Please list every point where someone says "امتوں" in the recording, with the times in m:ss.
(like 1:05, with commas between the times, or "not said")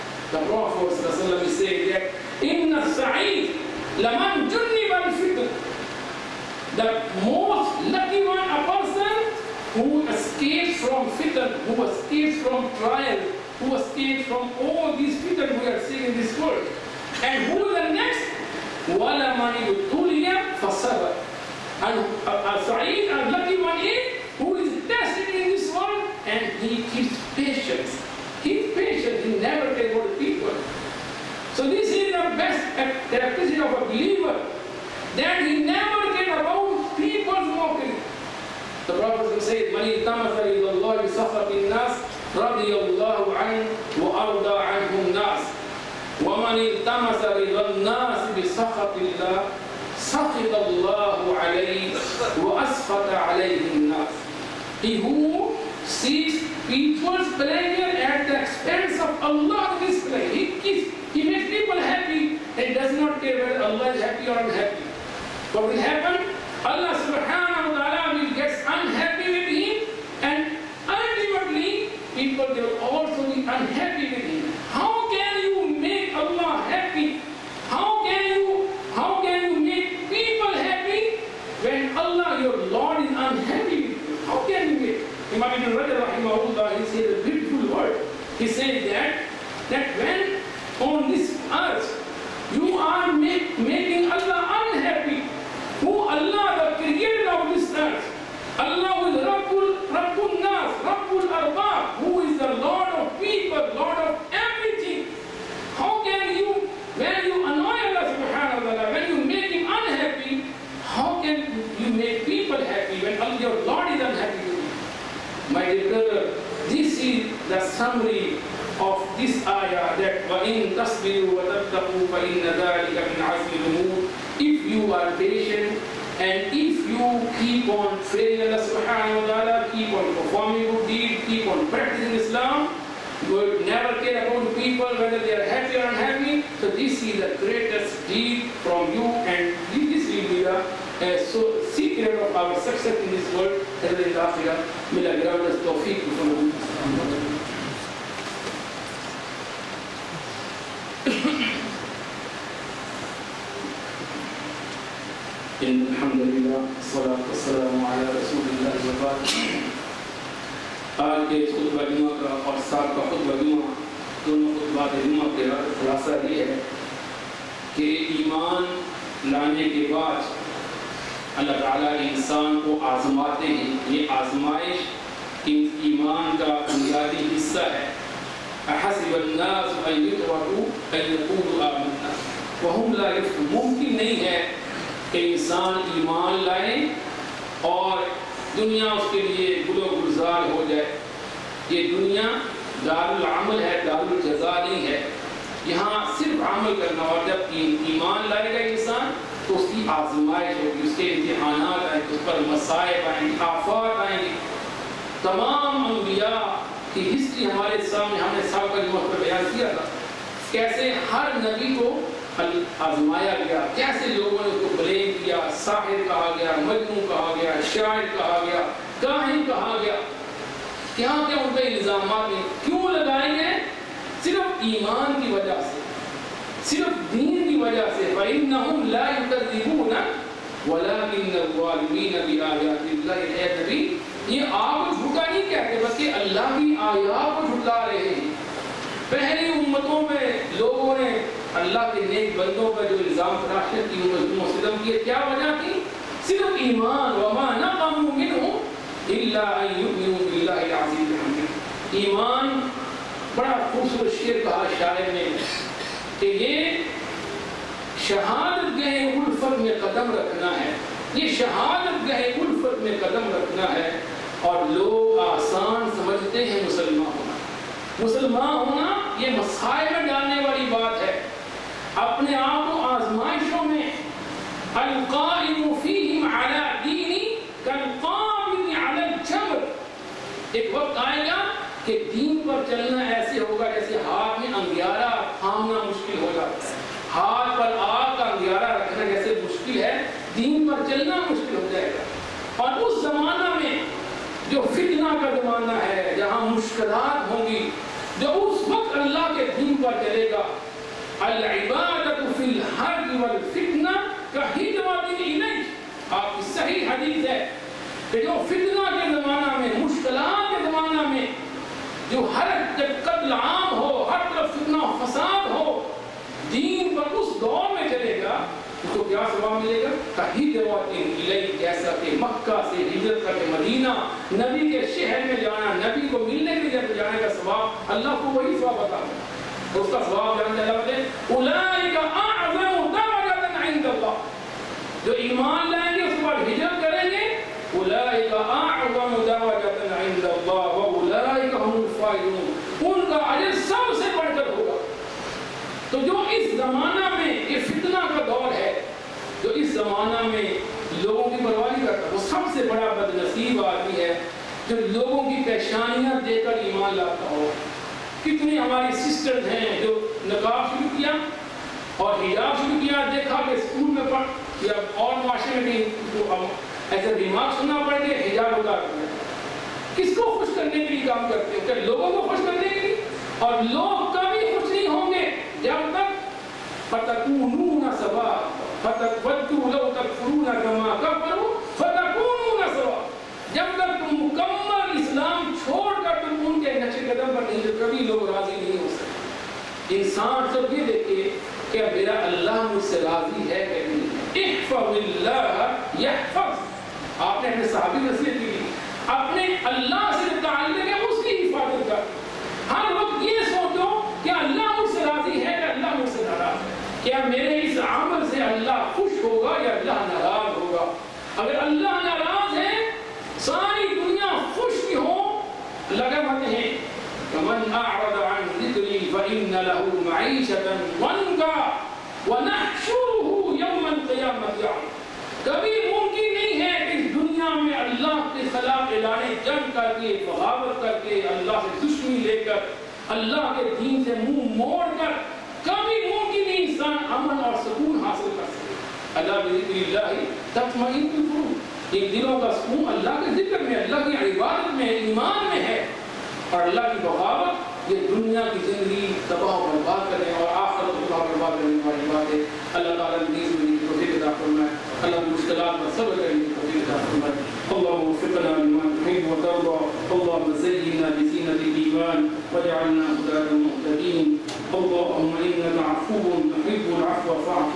3:59.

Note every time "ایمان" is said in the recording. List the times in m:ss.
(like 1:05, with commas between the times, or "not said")
3:05, 3:17, 3:44, 4:06, 4:11, 5:56, 7:24.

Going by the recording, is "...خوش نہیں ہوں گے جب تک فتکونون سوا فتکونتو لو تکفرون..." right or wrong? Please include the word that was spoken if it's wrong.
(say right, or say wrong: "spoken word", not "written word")
right.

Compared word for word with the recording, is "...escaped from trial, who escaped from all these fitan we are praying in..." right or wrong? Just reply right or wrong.
wrong.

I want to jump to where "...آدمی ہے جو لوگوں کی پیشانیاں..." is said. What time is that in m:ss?
5:53.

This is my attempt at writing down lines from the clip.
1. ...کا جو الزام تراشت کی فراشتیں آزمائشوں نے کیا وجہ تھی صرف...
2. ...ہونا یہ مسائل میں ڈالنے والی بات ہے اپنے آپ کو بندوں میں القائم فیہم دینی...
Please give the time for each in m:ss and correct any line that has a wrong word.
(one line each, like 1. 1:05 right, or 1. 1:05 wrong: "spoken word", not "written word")
1. 4:02 wrong: "انہوں", not "آزمائشوں"
2. 4:28 wrong: "آزمائشوں", not "بندوں".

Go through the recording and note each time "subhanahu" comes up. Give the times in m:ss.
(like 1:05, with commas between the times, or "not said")
1:06, 2:08.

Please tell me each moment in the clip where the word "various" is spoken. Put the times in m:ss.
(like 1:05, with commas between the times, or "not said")
not said.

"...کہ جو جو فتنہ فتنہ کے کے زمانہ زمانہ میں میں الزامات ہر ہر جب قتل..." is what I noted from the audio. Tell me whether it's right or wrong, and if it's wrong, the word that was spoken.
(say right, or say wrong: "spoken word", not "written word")
wrong: "مشکلات", not "الزامات".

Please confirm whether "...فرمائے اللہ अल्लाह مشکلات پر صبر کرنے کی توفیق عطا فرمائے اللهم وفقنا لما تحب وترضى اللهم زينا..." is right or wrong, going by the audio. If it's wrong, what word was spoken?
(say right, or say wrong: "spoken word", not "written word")
right.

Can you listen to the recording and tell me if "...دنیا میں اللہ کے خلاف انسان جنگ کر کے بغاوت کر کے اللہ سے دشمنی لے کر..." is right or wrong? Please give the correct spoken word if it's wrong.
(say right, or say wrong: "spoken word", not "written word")
wrong: "اعلان", not "انسان".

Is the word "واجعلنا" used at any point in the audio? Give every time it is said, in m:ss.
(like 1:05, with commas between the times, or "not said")
7:42.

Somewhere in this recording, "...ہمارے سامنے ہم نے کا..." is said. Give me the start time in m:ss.
3:27.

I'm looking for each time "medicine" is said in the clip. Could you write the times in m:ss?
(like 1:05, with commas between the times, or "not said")
not said.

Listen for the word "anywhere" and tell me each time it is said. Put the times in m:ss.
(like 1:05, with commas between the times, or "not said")
not said.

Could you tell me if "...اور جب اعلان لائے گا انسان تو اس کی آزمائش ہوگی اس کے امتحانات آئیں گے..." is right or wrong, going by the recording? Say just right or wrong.
wrong.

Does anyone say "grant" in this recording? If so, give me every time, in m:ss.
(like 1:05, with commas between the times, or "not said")
2:25.